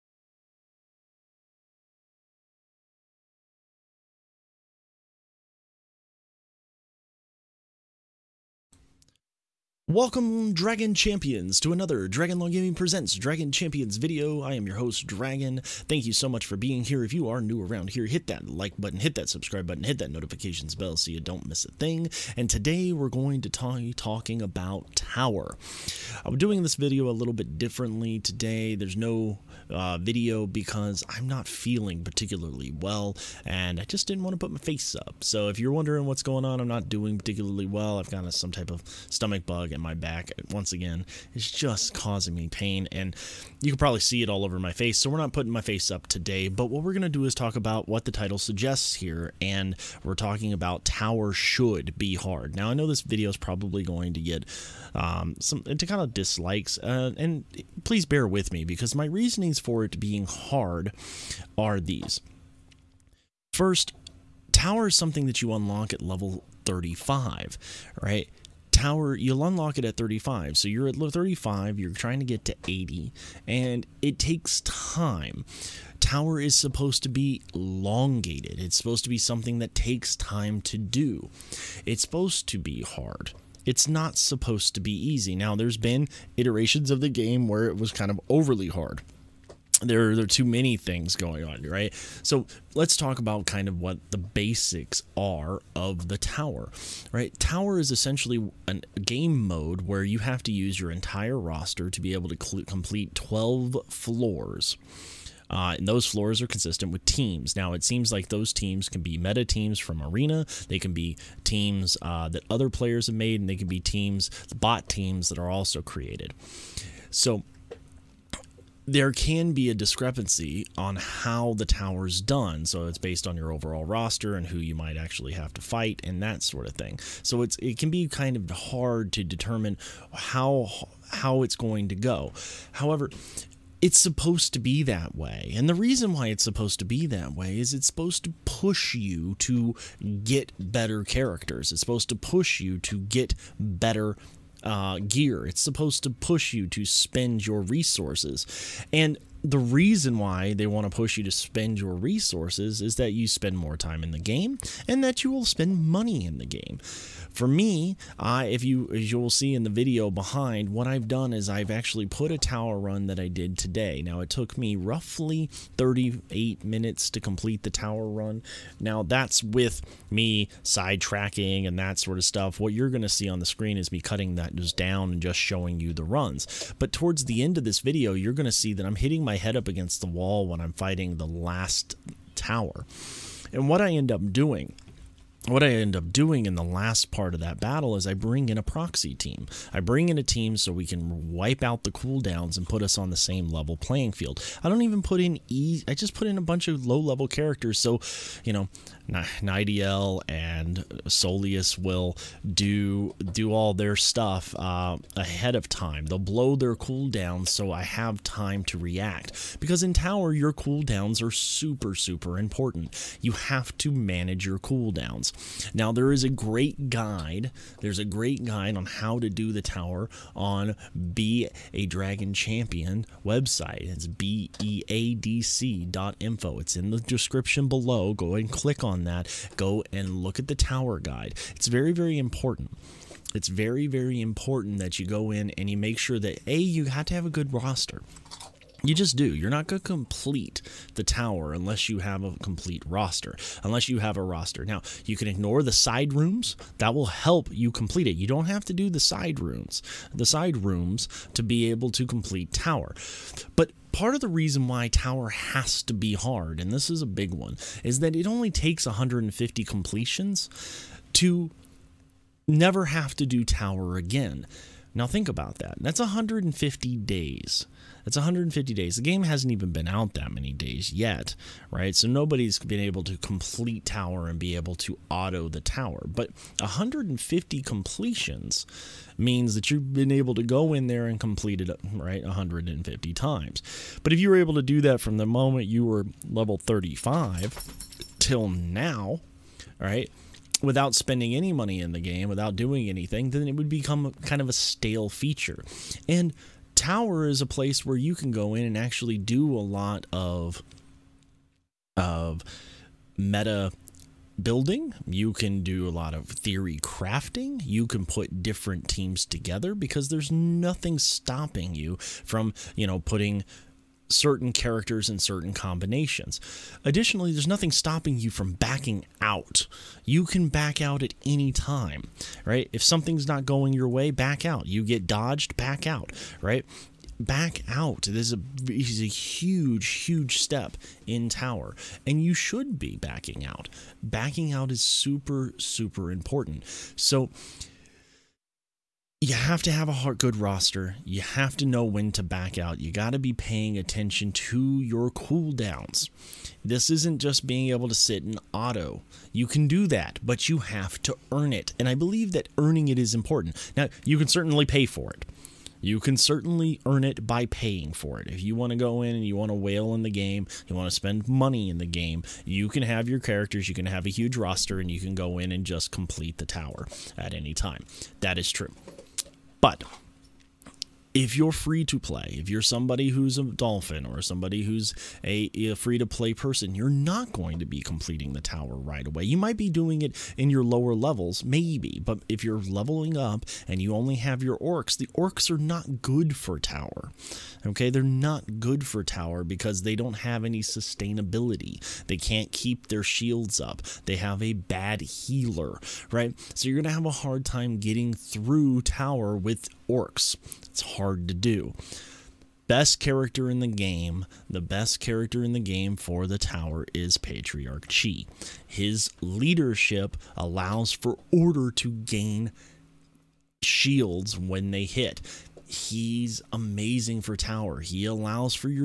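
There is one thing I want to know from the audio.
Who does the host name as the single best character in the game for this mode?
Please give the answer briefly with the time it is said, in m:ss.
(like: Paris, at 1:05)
Patriarch Chi, at 6:47.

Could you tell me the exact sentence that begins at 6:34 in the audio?
They have a bad healer, right?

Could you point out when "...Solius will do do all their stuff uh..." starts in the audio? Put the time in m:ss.
3:21.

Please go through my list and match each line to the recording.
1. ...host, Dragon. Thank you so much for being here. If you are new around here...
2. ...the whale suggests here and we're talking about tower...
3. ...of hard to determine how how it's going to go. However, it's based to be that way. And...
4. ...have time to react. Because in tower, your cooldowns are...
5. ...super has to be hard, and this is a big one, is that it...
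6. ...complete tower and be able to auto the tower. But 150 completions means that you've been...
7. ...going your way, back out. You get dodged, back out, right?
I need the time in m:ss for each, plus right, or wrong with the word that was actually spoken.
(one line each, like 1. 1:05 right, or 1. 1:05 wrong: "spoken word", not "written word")
1. 0:14 right
2. 0:48 wrong: "title", not "whale"
3. 2:08 wrong: "supposed", not "based"
4. 3:27 right
5. 4:14 wrong: "tower", not "super"
6. 4:33 right
7. 5:23 right.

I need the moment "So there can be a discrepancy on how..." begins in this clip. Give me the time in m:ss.
1:57.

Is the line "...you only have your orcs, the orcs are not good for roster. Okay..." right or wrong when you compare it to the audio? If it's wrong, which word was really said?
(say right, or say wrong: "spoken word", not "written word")
wrong: "tower", not "roster".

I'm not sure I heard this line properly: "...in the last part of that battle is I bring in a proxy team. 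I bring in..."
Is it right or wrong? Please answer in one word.
right.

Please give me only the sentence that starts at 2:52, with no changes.
What you're going to see on the screen is me cutting that just down and just showing you the runs.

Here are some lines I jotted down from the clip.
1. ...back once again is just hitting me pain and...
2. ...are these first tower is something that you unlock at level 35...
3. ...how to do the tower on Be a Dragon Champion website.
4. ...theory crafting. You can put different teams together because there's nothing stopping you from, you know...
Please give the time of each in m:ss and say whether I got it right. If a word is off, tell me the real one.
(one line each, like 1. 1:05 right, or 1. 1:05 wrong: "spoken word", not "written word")
1. 0:39 wrong: "causing", not "hitting"
2. 1:01 right
3. 3:38 right
4. 5:06 right.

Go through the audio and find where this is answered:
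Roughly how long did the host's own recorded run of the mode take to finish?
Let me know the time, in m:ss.
2:45.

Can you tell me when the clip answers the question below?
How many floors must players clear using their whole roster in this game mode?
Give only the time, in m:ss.
1:43.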